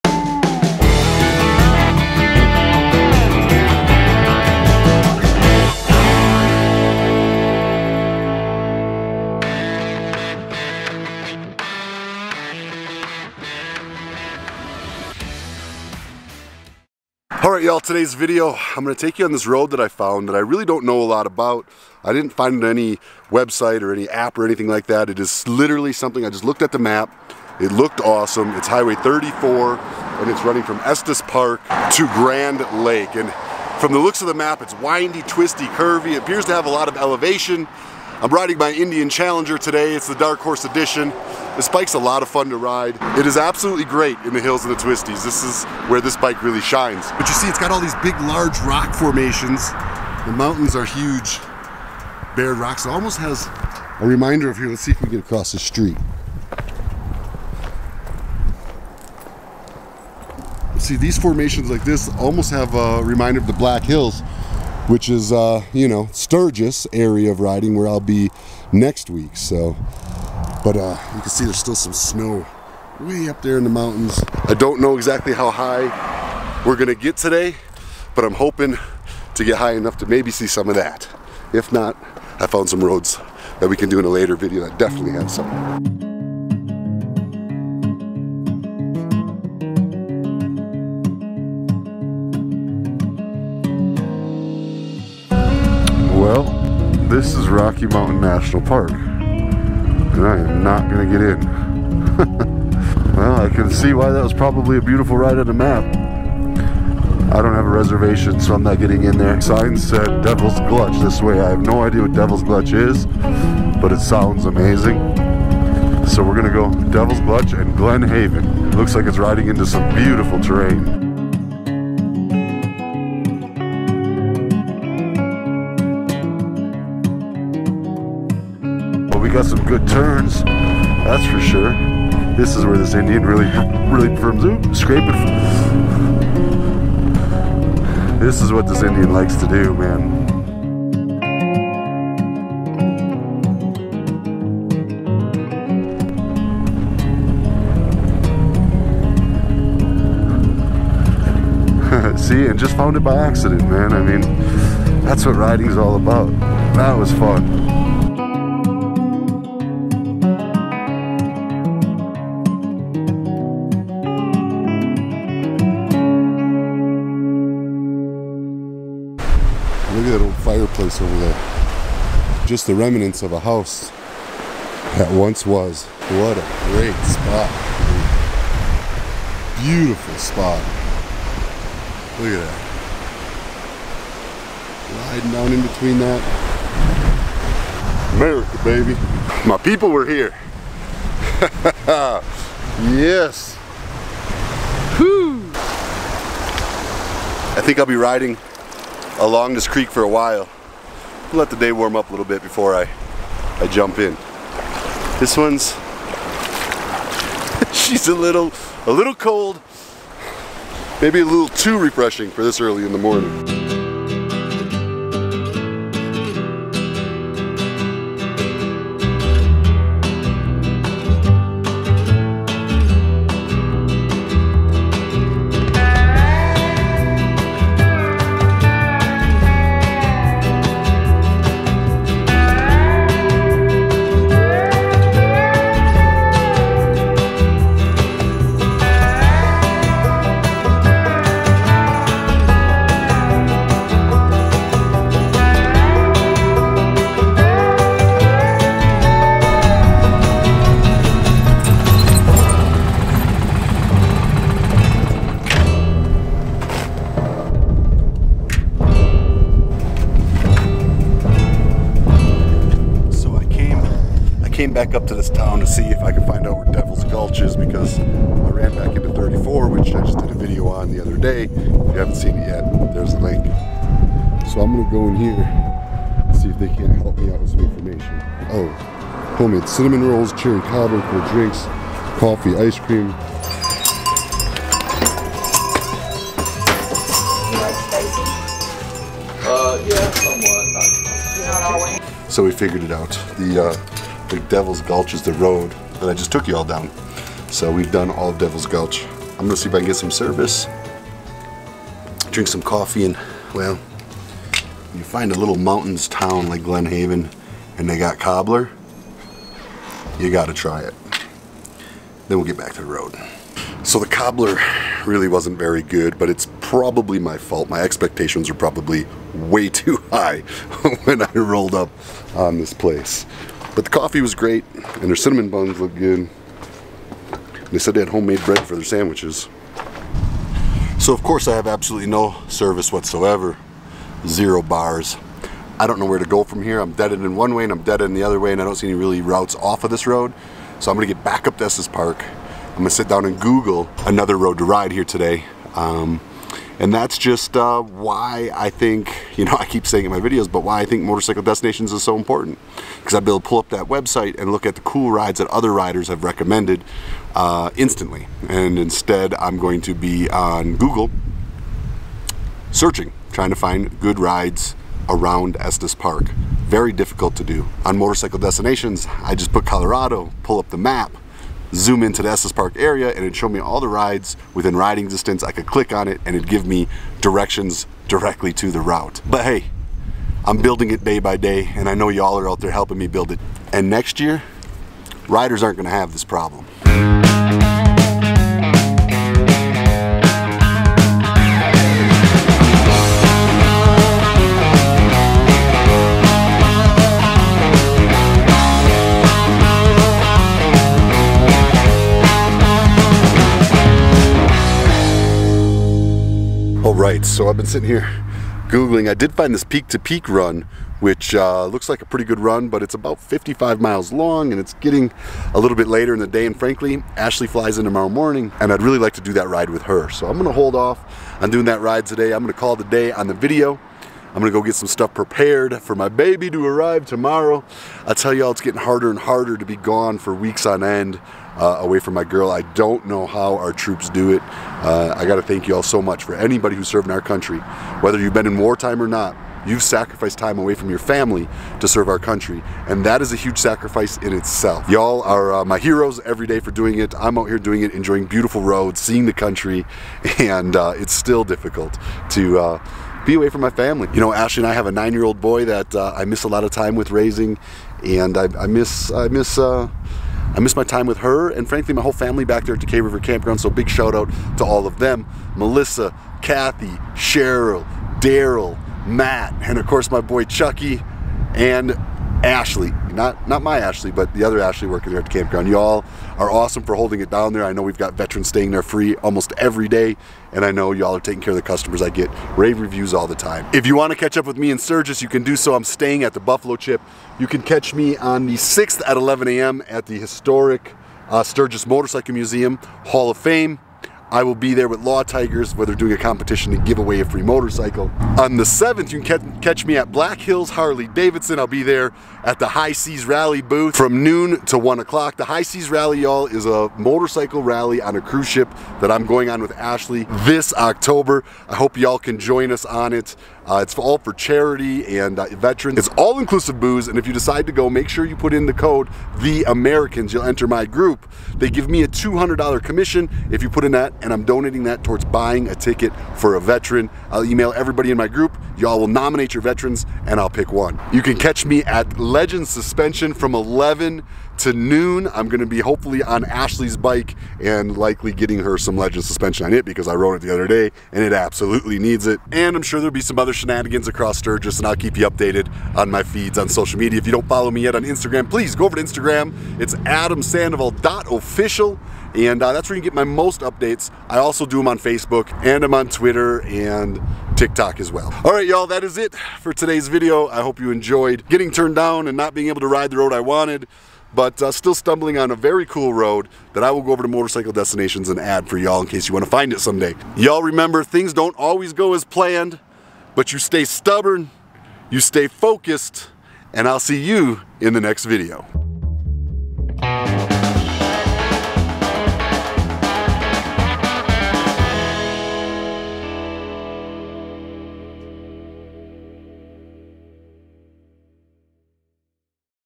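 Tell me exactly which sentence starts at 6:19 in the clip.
But hey, I'm building it day by day and I know y'all are out there helping me build it.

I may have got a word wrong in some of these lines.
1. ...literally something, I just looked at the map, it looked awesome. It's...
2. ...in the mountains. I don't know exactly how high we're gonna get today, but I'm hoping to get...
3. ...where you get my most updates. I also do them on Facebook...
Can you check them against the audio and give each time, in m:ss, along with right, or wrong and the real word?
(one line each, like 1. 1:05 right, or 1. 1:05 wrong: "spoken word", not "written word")
1. 0:25 right
2. 1:13 right
3. 9:12 right.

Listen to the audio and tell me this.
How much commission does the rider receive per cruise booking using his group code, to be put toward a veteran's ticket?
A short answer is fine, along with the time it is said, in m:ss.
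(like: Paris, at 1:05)
$200, at 8:42.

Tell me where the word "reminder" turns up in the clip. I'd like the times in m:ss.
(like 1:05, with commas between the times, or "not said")
0:54, 1:03.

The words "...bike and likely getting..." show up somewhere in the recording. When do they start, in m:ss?
8:56.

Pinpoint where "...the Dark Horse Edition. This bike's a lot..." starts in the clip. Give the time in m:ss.
0:40.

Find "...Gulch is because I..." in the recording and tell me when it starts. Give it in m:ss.
4:27.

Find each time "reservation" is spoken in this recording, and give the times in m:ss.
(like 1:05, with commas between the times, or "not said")
1:47.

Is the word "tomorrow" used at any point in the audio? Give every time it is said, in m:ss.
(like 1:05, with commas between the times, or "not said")
6:57, 7:07.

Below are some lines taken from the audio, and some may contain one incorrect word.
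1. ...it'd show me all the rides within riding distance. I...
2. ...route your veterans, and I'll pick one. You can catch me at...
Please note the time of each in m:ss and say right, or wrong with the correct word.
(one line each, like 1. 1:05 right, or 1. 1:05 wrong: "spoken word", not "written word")
1. 6:13 right
2. 8:49 wrong: "nominate", not "route".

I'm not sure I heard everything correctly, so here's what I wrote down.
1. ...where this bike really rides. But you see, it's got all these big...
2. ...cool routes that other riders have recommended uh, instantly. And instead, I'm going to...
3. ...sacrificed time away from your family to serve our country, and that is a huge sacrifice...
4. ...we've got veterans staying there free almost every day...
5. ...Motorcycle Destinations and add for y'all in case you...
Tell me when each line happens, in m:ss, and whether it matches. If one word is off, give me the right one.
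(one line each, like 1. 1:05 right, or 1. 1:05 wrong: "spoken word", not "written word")
1. 0:45 wrong: "shines", not "rides"
2. 5:54 wrong: "rides", not "routes"
3. 7:19 right
4. 7:57 right
5. 9:27 right.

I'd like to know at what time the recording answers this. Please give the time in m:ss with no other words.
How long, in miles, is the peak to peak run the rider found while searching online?
6:53.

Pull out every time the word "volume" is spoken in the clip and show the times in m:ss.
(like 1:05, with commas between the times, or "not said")
not said.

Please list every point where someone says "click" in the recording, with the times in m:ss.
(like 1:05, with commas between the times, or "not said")
6:15.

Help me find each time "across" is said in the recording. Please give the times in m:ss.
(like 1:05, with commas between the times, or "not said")
0:55, 9:04.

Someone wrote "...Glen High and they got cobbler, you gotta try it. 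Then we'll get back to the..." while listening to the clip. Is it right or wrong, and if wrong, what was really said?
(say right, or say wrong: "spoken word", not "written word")
wrong: "Haven", not "High".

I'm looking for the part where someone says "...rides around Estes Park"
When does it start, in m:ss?
6:04.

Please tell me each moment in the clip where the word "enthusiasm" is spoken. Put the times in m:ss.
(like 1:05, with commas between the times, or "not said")
not said.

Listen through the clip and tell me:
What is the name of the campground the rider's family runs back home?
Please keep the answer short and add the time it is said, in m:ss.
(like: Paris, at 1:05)
Deep River Campground, at 7:42.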